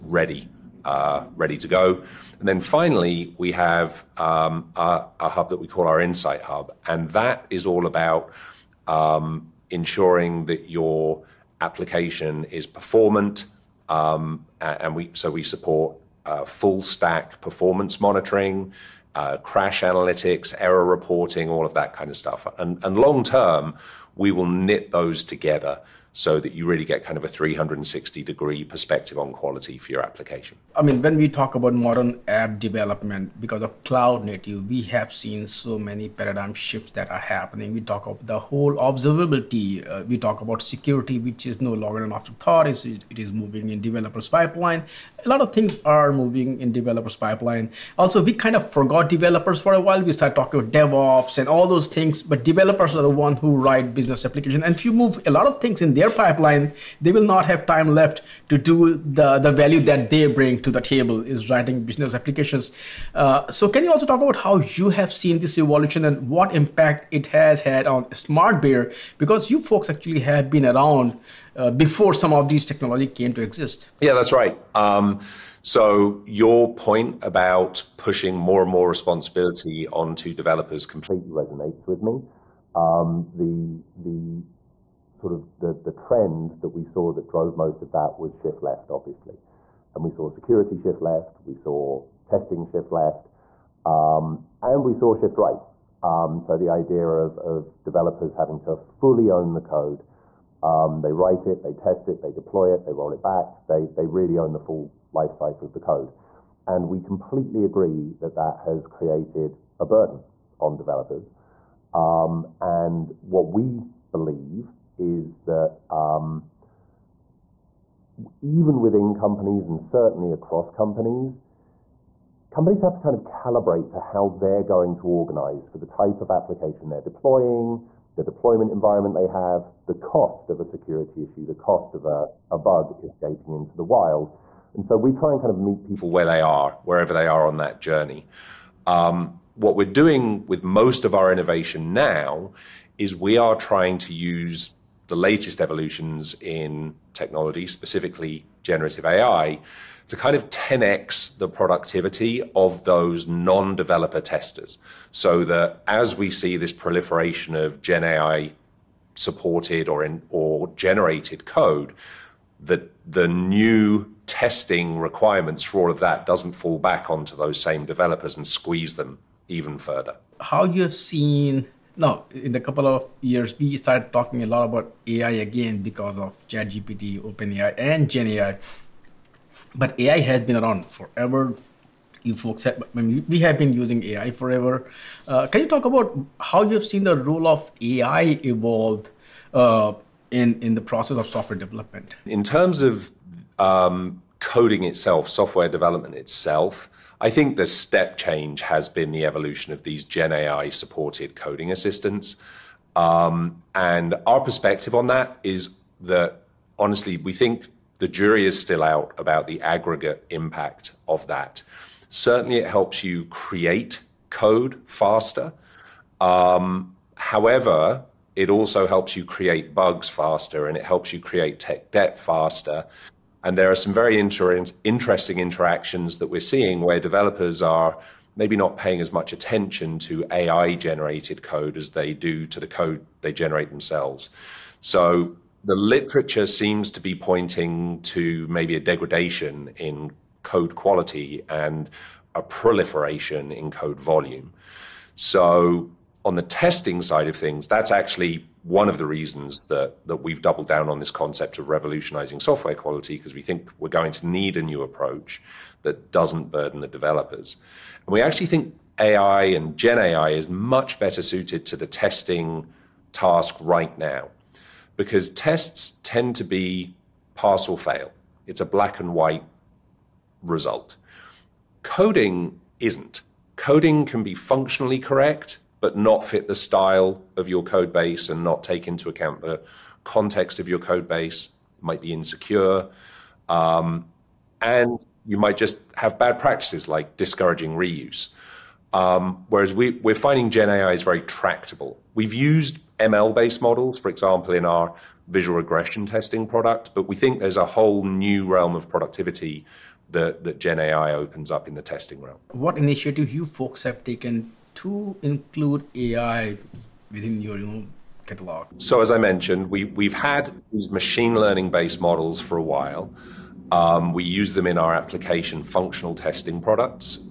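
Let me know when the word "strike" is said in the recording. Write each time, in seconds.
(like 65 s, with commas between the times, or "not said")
not said.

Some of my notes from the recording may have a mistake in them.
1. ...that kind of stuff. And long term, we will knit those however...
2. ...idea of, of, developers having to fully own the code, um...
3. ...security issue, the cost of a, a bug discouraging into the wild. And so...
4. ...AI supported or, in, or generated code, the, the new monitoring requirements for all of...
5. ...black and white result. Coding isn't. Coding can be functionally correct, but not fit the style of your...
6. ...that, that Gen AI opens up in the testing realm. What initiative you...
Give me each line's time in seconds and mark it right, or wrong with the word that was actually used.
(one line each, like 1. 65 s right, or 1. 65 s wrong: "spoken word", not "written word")
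1. 21 s wrong: "together", not "however"
2. 96 s right
3. 130 s wrong: "escaping", not "discouraging"
4. 158 s wrong: "testing", not "monitoring"
5. 268 s right
6. 300 s right.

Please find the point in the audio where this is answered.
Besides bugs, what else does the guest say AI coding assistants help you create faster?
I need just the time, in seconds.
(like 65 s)
221 s.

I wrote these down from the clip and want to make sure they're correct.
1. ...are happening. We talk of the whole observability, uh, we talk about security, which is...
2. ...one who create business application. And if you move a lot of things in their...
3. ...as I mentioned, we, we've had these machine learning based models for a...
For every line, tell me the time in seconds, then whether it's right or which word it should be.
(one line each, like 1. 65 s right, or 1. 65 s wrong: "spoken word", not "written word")
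1. 37 s right
2. 53 s wrong: "write", not "create"
3. 309 s right.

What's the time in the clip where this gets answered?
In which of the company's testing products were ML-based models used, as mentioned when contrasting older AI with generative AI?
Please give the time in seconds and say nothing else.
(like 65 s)
295 s.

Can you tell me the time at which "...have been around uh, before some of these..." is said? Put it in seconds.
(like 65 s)
70 s.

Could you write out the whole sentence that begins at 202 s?
Um, and our perspective on that is that honestly, we think the jury is still out about the aggregate impact of that.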